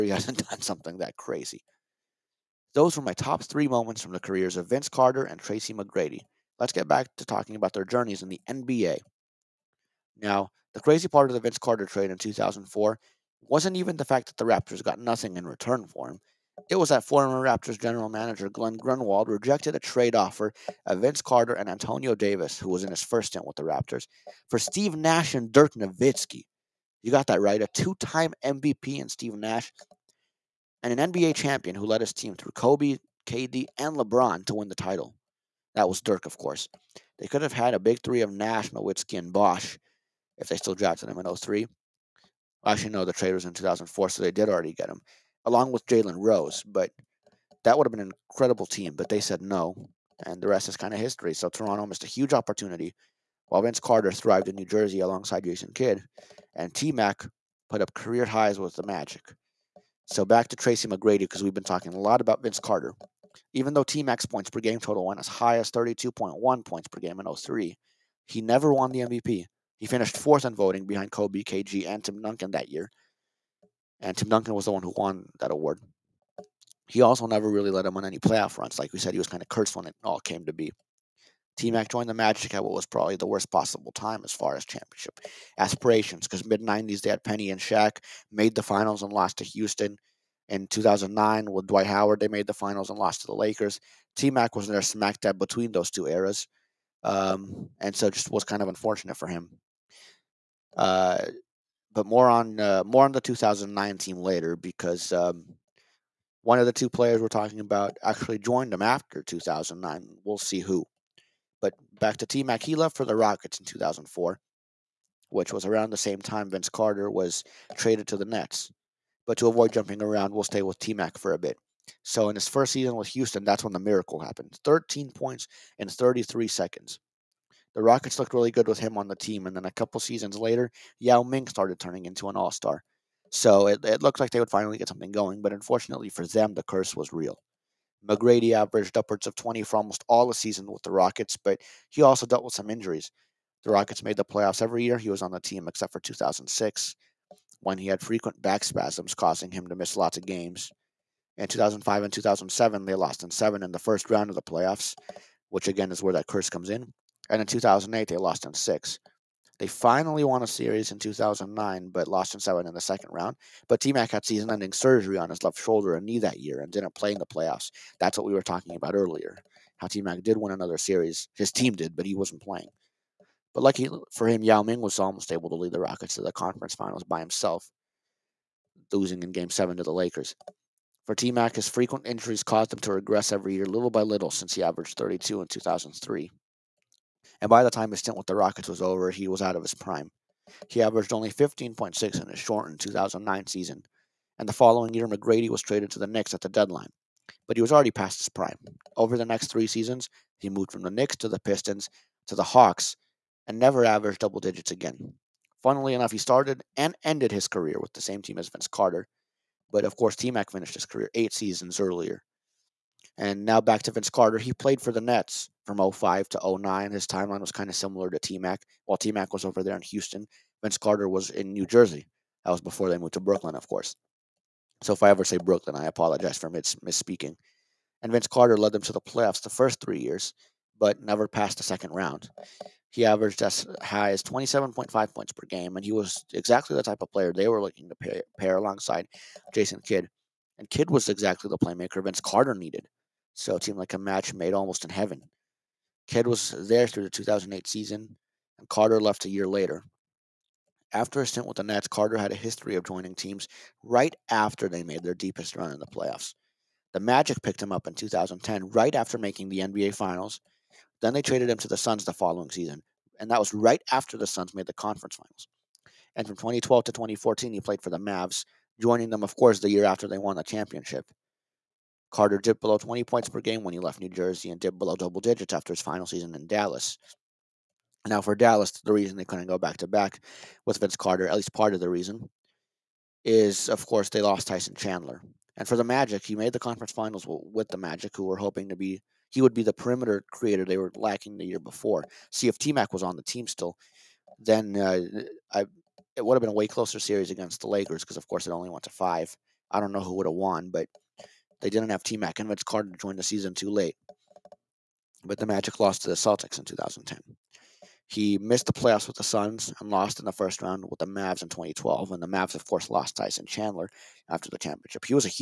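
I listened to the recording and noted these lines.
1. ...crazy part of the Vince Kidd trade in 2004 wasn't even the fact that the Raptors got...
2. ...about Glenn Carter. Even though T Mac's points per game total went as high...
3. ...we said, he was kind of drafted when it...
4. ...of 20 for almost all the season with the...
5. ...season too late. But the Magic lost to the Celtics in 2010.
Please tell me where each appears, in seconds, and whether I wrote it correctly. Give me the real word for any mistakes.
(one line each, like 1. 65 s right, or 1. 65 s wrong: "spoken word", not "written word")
1. 10 s wrong: "Carter", not "Kidd"
2. 62 s wrong: "Vince", not "Glenn"
3. 78 s wrong: "cursed", not "drafted"
4. 139 s right
5. 303 s right.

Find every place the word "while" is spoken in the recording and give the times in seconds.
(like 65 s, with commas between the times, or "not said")
53 s, 218 s.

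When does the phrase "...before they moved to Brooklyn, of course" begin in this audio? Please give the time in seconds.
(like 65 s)
222 s.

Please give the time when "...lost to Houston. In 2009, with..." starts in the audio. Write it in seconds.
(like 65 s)
89 s.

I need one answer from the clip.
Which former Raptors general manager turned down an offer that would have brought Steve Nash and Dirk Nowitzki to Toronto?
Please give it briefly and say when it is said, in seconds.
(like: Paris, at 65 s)
Glenn Grunwald, at 18 s.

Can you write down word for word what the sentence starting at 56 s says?
And T Mac put up career highs with the Magic.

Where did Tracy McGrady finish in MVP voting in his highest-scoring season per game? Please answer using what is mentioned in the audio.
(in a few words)
fourth.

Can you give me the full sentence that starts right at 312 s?
And the Mavs, of course, lost Tyson Chandler after the championship.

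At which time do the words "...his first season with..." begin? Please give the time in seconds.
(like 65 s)
122 s.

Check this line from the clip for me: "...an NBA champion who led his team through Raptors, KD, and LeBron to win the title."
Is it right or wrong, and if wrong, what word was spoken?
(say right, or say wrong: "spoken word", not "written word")
wrong: "Kobe", not "Raptors".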